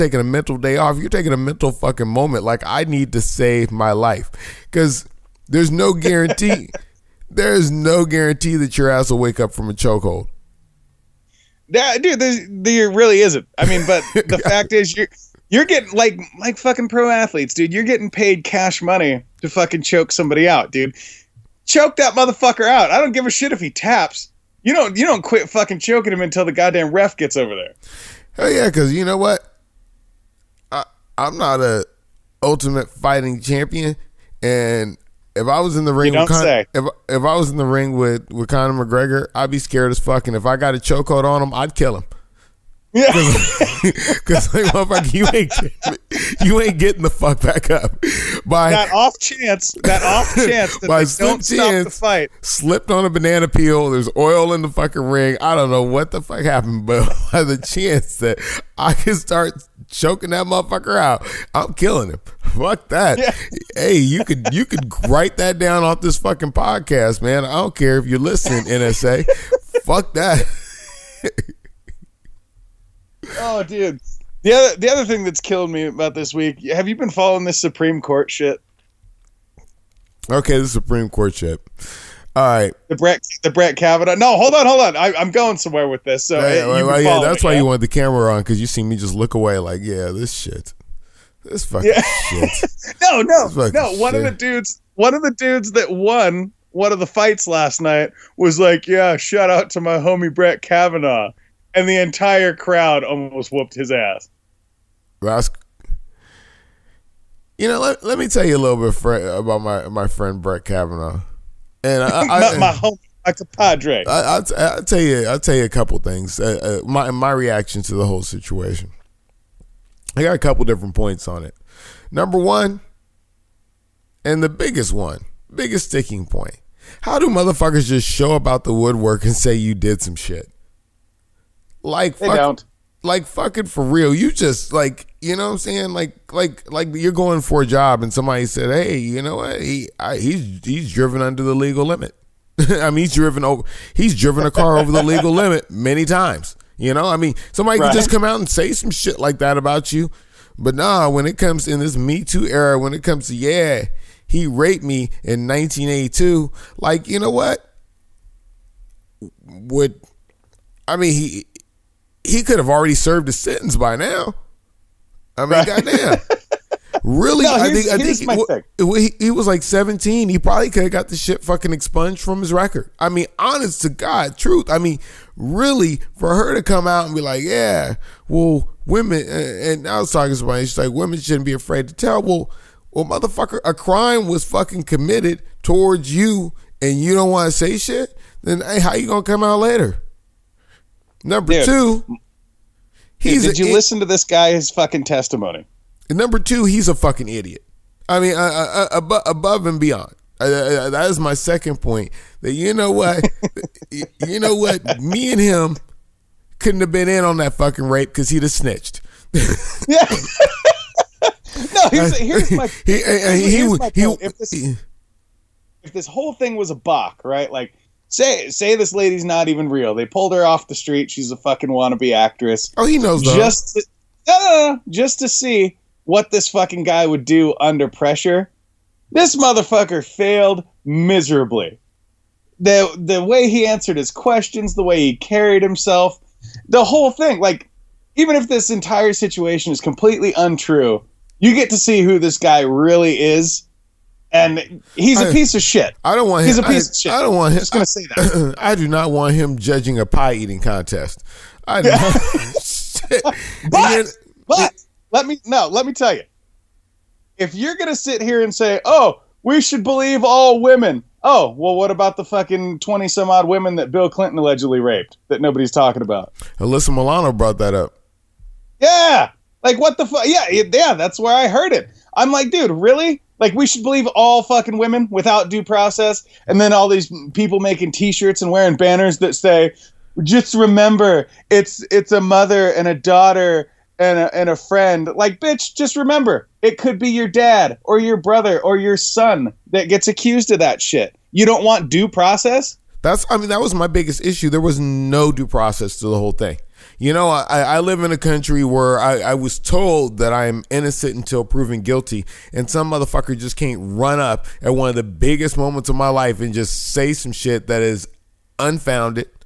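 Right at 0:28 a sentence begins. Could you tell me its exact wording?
Hell yeah, because you know what?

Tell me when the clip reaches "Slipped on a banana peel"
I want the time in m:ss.
0:52.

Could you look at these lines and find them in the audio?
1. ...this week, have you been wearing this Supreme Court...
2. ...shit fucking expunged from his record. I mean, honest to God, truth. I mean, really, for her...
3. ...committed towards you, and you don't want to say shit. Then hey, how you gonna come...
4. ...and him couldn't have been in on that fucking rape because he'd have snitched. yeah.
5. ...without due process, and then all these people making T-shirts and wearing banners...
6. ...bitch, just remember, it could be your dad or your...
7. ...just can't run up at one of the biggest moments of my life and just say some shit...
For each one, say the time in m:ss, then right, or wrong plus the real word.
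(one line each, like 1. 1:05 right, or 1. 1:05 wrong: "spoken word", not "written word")
1. 1:16 wrong: "following", not "wearing"
2. 2:51 right
3. 3:04 right
4. 3:25 right
5. 4:35 right
6. 4:45 right
7. 5:03 right.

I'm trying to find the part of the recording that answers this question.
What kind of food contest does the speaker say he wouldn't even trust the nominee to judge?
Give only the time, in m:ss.
4:10.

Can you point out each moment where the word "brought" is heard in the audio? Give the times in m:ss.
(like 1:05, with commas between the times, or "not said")
4:27.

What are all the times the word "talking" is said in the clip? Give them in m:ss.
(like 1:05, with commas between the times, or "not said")
3:00, 4:25.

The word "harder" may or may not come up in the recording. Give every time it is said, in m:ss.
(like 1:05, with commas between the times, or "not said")
not said.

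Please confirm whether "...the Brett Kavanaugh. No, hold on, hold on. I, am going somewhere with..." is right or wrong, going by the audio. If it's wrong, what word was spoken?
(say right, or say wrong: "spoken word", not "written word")
right.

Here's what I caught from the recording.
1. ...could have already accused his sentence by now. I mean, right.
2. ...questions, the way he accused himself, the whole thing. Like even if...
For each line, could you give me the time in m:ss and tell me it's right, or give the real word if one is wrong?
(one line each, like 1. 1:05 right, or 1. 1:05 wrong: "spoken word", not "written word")
1. 2:42 wrong: "served", not "accused"
2. 3:54 wrong: "carried", not "accused".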